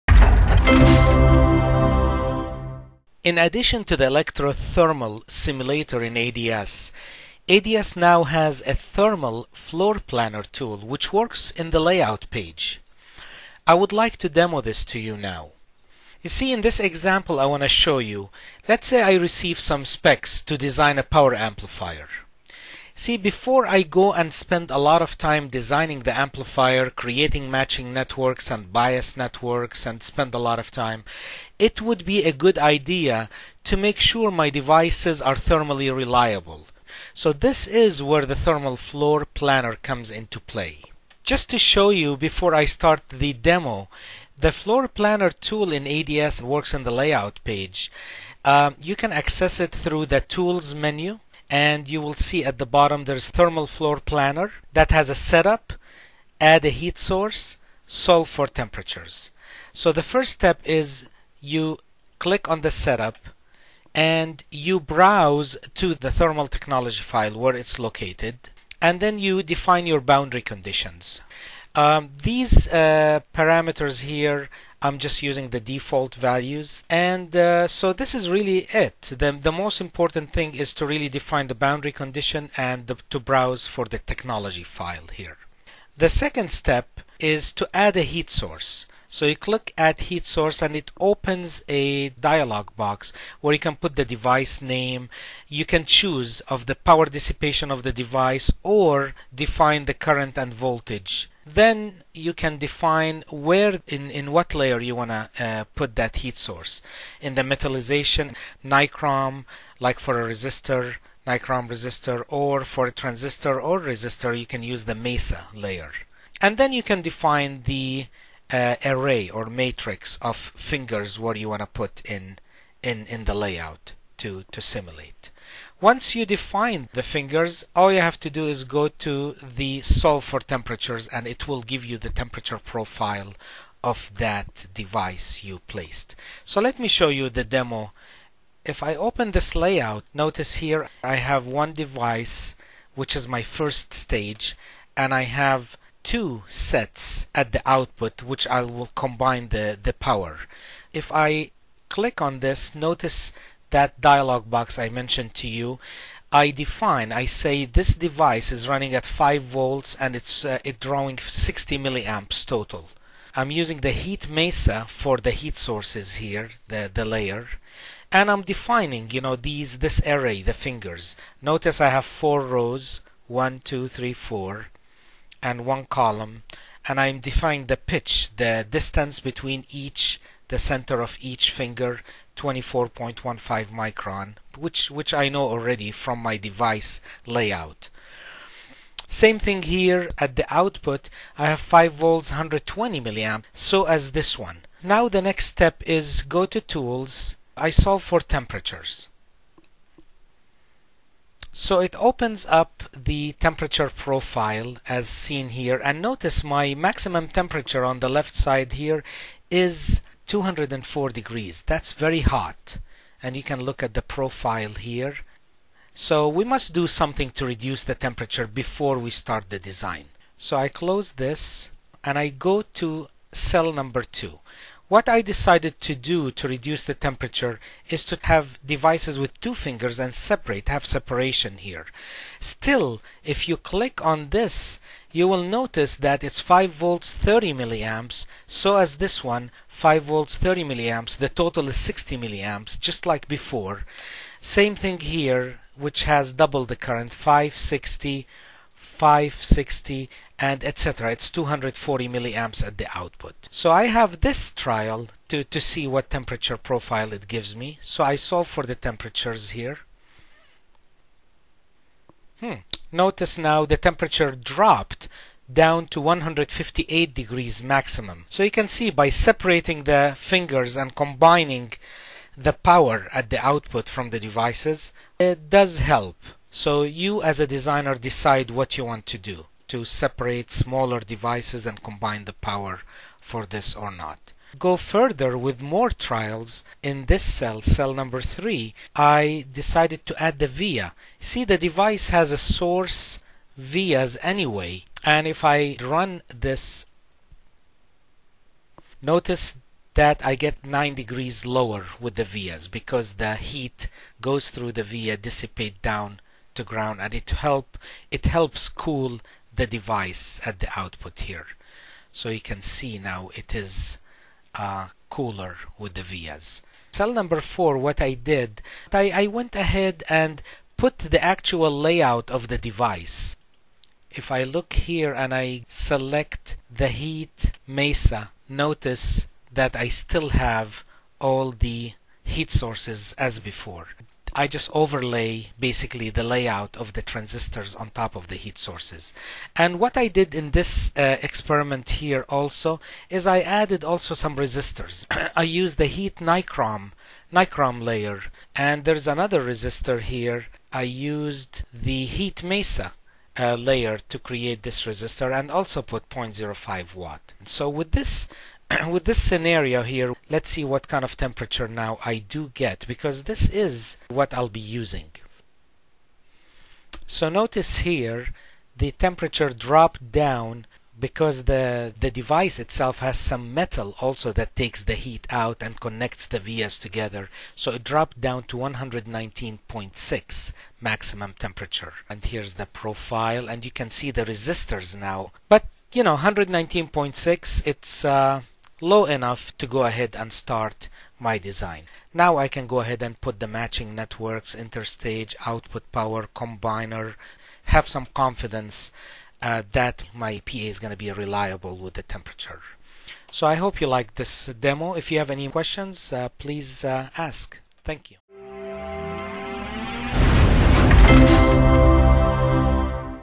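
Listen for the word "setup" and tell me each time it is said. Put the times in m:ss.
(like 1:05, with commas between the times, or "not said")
0:55, 1:02.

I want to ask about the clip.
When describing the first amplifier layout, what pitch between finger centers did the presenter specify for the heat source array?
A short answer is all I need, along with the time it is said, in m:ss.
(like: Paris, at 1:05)
24.15 micron, at 3:02.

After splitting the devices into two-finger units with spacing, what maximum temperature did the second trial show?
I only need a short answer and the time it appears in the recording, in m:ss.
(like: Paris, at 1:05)
158 degrees, at 4:26.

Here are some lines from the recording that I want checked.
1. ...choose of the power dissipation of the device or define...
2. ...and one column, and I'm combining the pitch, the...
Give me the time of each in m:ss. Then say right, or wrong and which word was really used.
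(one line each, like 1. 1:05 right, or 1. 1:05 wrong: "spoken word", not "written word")
1. 1:35 right
2. 2:55 wrong: "defining", not "combining".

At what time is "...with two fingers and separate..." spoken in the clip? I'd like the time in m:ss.
3:49.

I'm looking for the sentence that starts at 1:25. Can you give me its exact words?
The second step is to add a heat source.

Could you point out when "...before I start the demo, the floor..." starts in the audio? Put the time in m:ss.
0:42.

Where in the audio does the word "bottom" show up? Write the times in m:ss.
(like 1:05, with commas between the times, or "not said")
0:52.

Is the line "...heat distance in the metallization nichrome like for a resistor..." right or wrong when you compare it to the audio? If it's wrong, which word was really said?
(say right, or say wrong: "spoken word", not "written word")
wrong: "source", not "distance".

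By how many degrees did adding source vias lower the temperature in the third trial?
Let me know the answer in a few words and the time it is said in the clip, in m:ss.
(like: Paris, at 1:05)
9 degrees, at 5:00.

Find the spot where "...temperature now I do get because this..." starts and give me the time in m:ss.
6:01.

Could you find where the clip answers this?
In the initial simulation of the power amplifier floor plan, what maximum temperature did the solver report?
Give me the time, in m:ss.
3:30.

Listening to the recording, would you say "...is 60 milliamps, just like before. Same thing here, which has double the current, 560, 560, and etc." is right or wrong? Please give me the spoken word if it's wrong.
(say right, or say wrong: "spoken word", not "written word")
right.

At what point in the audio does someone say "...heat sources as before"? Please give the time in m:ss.
5:32.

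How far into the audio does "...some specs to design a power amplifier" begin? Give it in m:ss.
0:19.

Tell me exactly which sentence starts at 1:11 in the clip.
Um, these uh, parameters here, I'm just using the default values.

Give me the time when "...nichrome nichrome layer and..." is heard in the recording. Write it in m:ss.
5:46.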